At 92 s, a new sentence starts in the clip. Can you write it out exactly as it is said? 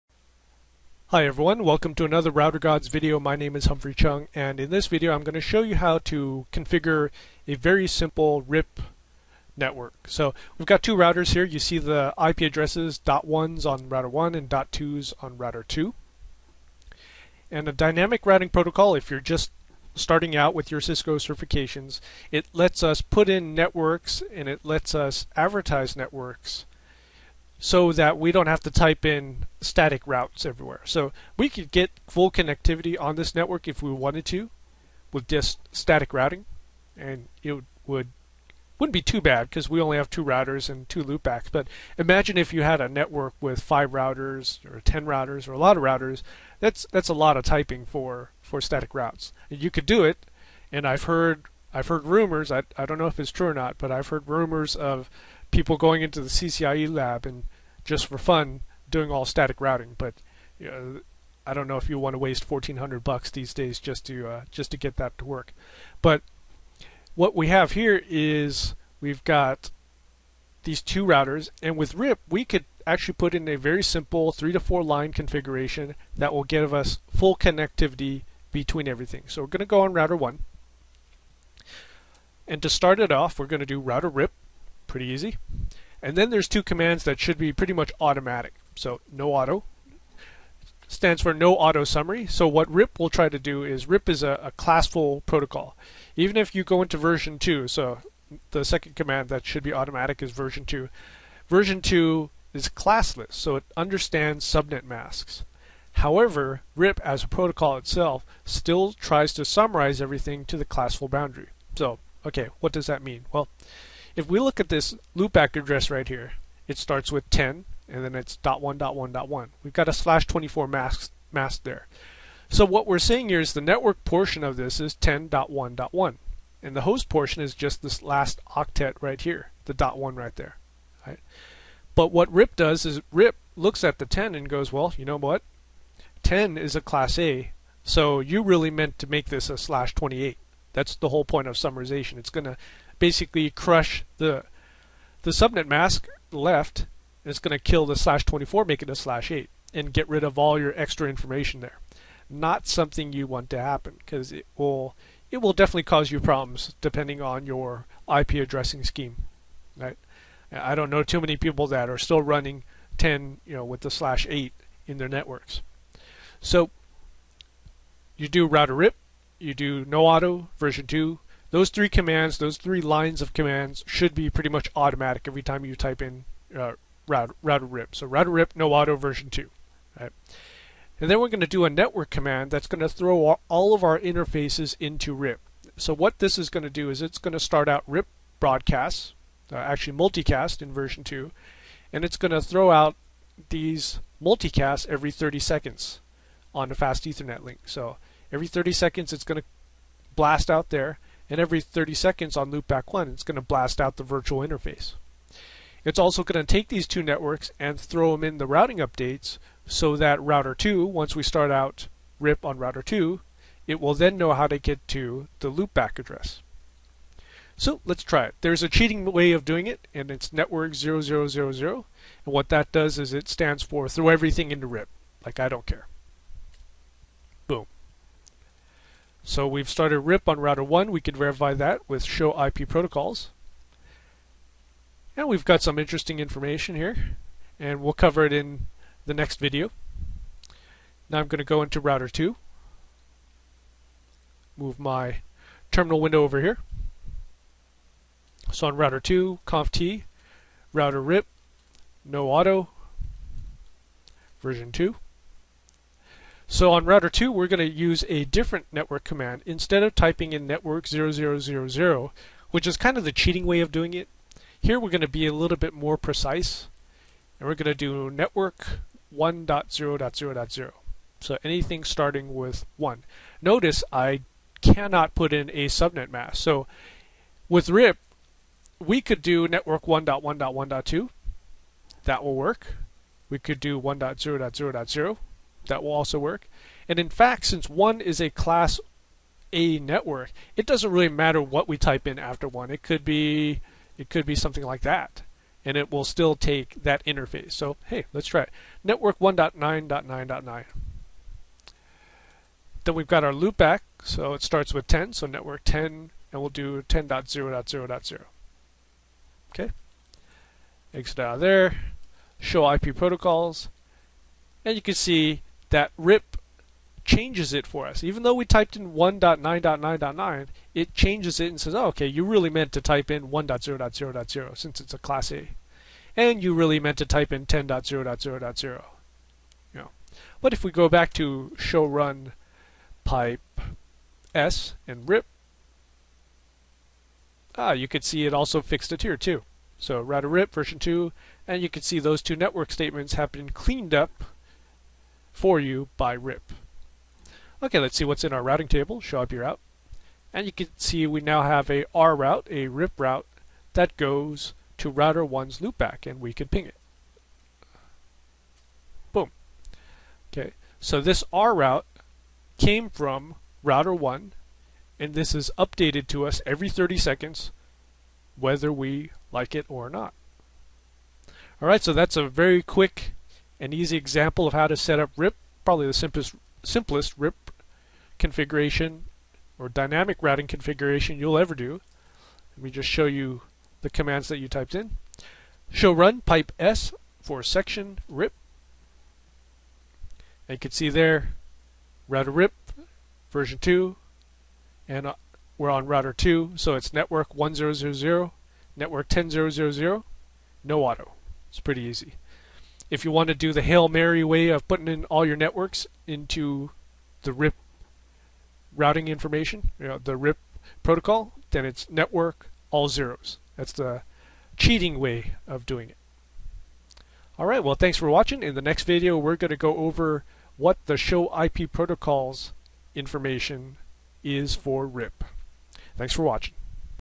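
So what RIP will try to do is RIP is a, a classful protocol.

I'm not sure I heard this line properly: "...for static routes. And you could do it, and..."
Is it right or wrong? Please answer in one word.
right.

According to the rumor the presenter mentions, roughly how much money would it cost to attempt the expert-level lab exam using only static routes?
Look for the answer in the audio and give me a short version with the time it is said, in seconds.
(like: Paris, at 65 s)
1400 dollars, at 62 s.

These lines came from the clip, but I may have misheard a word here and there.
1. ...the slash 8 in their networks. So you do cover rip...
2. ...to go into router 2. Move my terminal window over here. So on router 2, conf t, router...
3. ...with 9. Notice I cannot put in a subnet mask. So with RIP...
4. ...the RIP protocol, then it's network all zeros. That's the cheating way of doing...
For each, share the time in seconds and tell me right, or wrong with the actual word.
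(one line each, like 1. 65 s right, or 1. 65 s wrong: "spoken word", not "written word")
1. 163 s wrong: "router", not "cover"
2. 241 s right
3. 272 s wrong: "1", not "9"
4. 409 s right.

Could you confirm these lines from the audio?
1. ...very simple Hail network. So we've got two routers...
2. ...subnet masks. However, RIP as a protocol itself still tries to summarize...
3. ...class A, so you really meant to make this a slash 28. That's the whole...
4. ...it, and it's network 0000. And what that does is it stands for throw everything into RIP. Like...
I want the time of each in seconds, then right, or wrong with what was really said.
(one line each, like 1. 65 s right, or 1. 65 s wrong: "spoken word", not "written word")
1. 7 s wrong: "RIP", not "Hail"
2. 104 s right
3. 136 s right
4. 219 s right.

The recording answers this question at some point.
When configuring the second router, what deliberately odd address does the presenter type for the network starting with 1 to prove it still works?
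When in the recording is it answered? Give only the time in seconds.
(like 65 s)
298 s.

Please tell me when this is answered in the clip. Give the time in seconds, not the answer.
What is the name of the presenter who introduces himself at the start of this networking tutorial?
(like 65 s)
3 s.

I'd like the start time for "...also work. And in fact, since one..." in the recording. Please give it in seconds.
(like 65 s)
285 s.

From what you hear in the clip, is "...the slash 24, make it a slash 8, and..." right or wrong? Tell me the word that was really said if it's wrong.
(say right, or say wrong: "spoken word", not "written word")
right.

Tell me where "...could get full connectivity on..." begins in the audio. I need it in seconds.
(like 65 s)
31 s.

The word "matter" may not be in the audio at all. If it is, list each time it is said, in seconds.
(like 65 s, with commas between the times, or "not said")
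291 s.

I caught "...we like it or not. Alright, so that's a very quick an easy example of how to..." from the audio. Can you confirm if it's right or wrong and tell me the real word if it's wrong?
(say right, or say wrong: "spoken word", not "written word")
right.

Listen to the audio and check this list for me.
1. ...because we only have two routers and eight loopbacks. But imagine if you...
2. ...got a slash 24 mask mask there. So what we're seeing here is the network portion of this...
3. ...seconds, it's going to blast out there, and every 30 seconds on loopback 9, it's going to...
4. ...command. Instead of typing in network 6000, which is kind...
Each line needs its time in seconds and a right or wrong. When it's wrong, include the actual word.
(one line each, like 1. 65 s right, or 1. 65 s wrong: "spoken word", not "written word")
1. 39 s wrong: "two", not "eight"
2. 119 s right
3. 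198 s wrong: "1", not "9"
4. 259 s wrong: "0000", not "6000".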